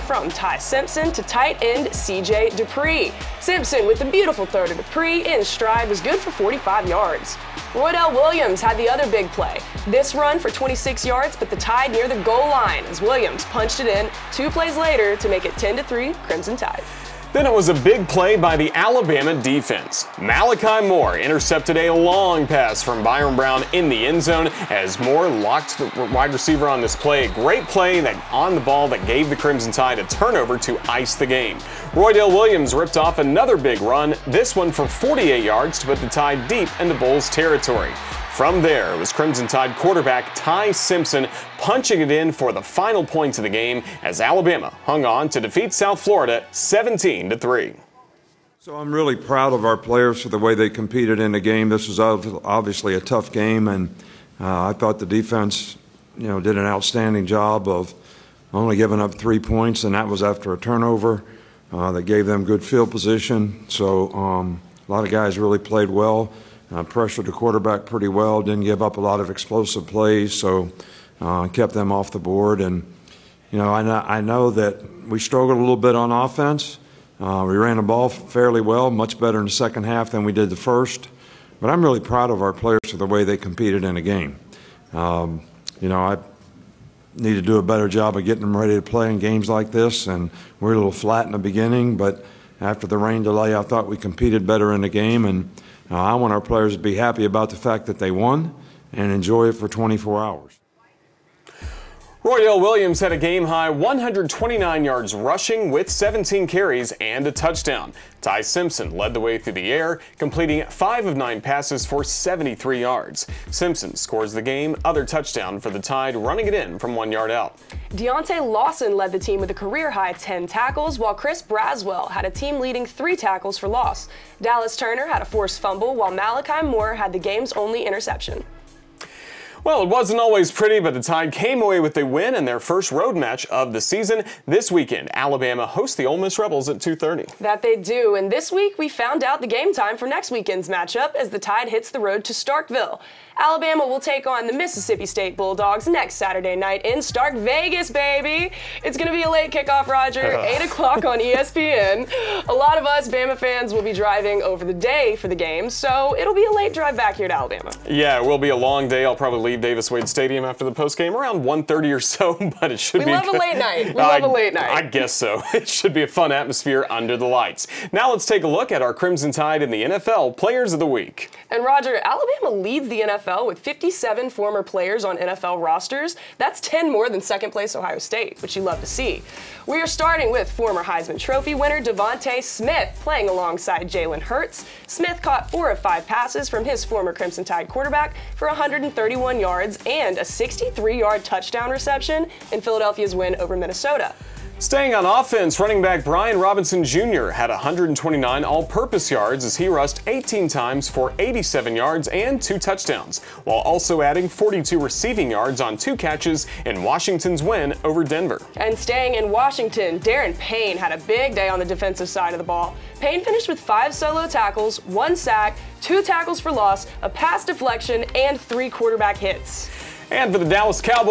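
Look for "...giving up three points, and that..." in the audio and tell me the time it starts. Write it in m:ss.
0:58.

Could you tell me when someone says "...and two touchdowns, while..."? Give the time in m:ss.
3:22.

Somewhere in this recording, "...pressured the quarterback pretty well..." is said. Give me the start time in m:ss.
1:06.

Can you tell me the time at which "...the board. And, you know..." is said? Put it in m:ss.
1:12.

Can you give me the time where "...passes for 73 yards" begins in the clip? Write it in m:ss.
1:51.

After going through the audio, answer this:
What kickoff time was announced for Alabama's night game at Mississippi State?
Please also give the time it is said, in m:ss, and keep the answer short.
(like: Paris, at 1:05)
8 o'clock, at 2:30.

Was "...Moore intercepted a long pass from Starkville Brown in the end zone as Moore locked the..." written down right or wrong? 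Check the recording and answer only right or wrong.
wrong.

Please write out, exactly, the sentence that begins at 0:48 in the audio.
So I'm really proud of our players for the way they competed in the game.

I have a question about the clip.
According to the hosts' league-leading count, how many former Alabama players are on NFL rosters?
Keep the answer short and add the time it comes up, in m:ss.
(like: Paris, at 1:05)
57, at 2:53.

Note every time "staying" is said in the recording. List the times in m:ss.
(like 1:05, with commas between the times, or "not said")
3:14, 3:28.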